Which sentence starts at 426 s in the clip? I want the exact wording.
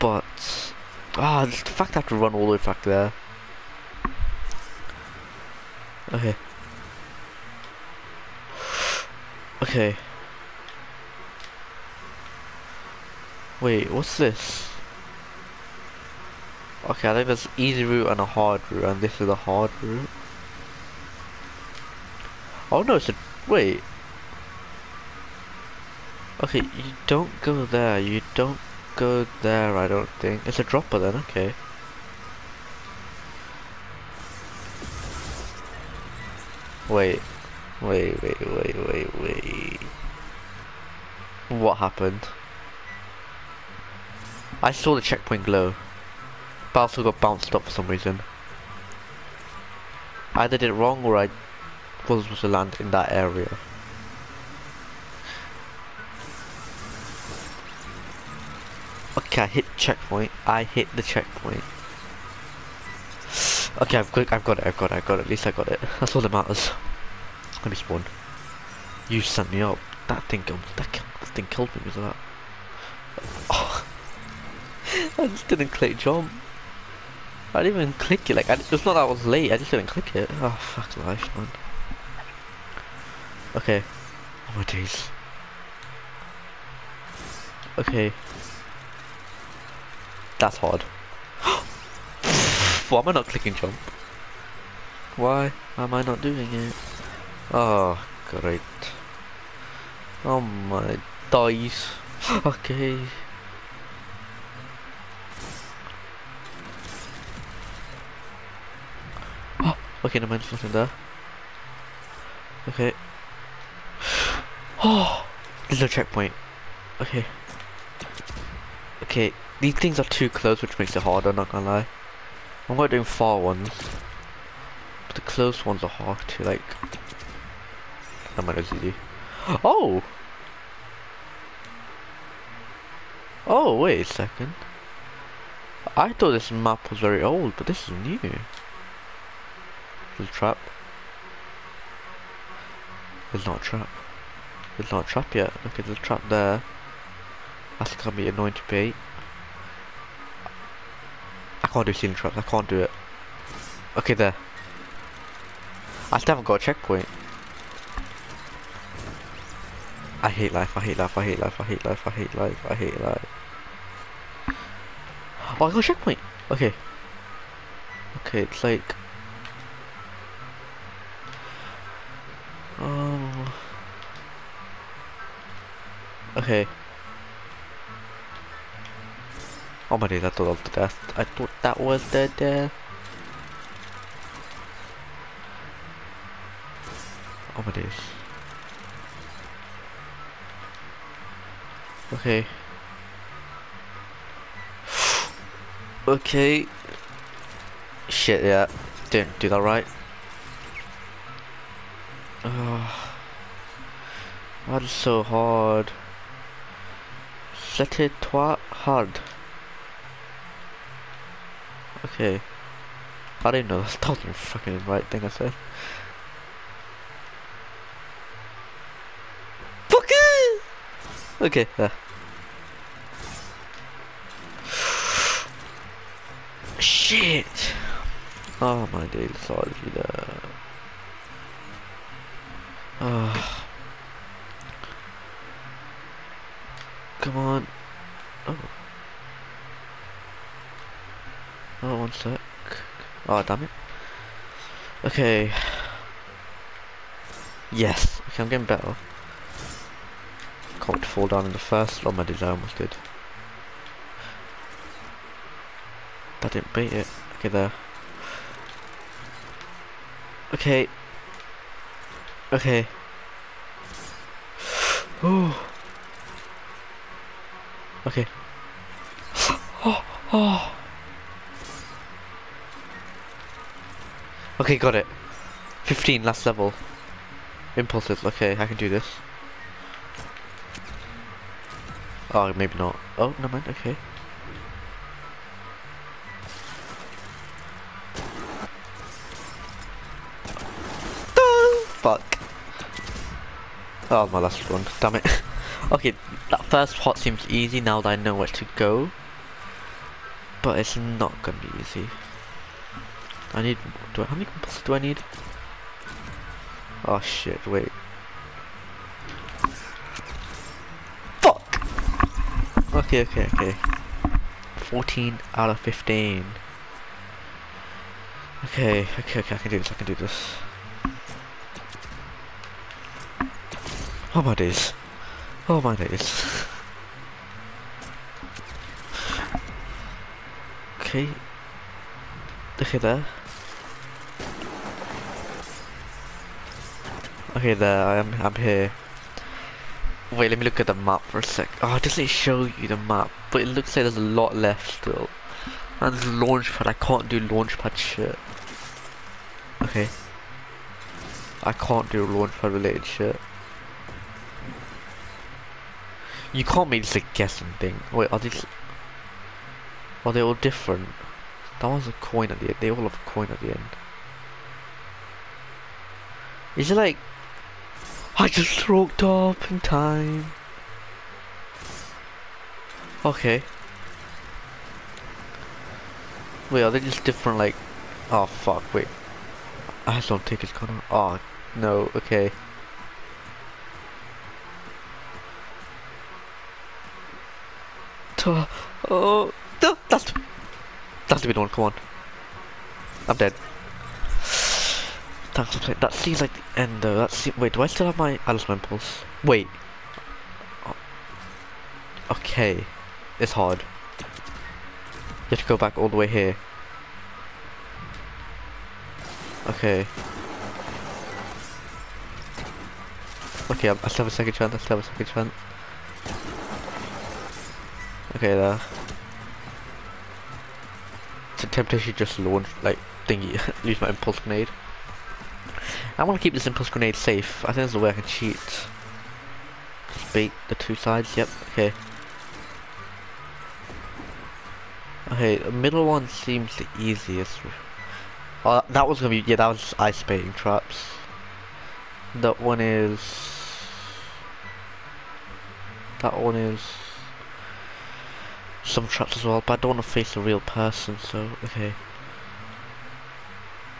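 I want to keep this impulse grenade safe.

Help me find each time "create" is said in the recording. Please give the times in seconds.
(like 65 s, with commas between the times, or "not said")
not said.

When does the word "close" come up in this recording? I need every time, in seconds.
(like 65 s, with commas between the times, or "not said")
120 s, 125 s.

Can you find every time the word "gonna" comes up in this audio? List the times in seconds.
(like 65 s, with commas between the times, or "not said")
121 s, 147 s, 301 s, 380 s, 439 s.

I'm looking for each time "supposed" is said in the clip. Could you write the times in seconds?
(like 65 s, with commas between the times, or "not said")
52 s.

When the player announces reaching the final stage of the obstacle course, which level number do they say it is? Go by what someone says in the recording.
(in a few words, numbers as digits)
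15.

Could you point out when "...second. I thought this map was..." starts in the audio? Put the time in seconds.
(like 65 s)
134 s.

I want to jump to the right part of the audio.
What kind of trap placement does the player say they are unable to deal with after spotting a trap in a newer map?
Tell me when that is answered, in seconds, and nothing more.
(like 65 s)
151 s.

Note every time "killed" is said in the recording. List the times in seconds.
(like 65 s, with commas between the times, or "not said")
71 s.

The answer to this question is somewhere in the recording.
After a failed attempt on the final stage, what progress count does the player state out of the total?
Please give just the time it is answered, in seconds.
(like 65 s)
314 s.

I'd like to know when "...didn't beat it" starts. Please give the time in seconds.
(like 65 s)
256 s.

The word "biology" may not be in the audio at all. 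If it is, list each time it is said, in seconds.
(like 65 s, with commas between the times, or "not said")
not said.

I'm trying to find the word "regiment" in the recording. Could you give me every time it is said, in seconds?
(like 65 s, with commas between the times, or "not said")
not said.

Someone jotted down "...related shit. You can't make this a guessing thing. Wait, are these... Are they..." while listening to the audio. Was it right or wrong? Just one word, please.
right.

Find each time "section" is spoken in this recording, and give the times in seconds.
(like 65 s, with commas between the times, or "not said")
not said.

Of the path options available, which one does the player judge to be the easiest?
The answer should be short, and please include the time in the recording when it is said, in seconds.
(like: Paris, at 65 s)
the middle one, at 435 s.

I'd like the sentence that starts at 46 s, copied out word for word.
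But I also got bounced up for some reason.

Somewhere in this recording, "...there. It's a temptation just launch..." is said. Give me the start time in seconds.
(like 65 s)
418 s.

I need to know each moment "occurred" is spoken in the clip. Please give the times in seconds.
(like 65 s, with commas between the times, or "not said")
not said.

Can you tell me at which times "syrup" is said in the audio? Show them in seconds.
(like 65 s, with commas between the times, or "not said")
not said.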